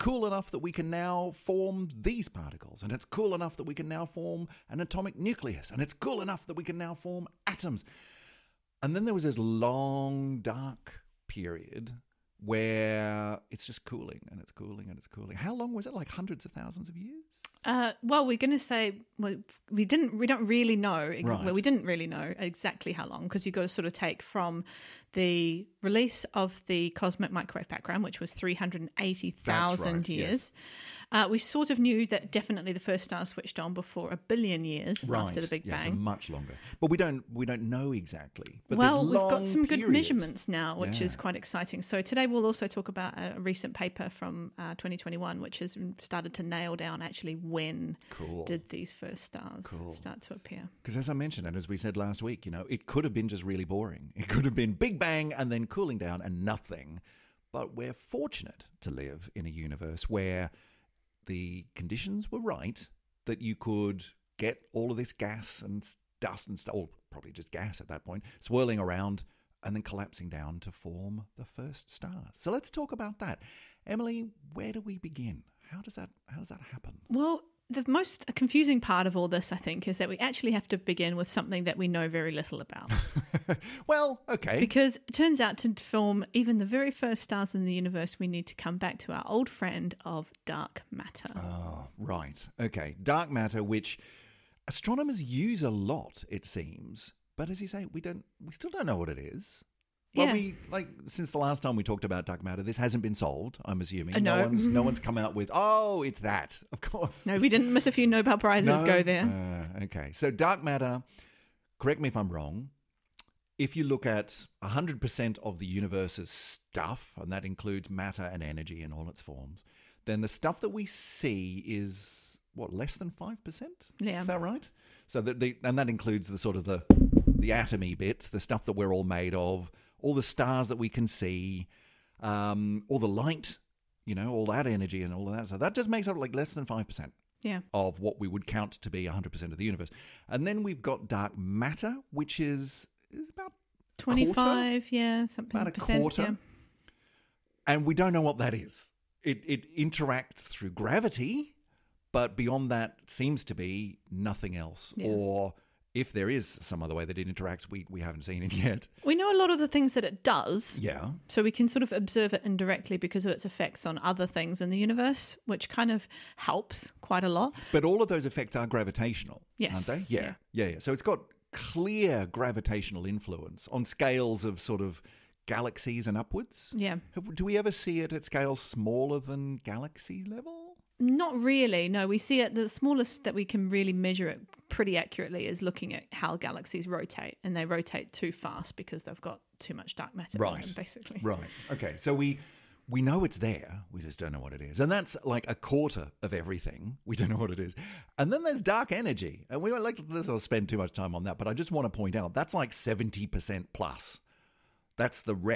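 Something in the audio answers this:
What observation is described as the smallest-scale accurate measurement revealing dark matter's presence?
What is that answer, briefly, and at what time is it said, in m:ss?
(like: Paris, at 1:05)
How galaxies rotate, at 3:06.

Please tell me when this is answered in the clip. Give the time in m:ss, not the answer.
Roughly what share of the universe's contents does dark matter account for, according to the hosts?
2:23.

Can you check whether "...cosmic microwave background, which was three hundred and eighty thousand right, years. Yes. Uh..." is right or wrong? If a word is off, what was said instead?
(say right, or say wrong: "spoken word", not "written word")
right.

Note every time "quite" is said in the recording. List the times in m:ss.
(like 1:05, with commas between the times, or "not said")
0:41, 2:46.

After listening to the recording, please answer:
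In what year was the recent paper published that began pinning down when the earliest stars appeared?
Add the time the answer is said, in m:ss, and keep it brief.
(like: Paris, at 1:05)
2021, at 0:44.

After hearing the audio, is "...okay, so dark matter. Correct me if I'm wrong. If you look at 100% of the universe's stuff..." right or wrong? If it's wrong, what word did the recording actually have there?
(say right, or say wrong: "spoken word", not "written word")
right.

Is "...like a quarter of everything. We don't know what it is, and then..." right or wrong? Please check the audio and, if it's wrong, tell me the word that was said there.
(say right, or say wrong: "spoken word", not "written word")
right.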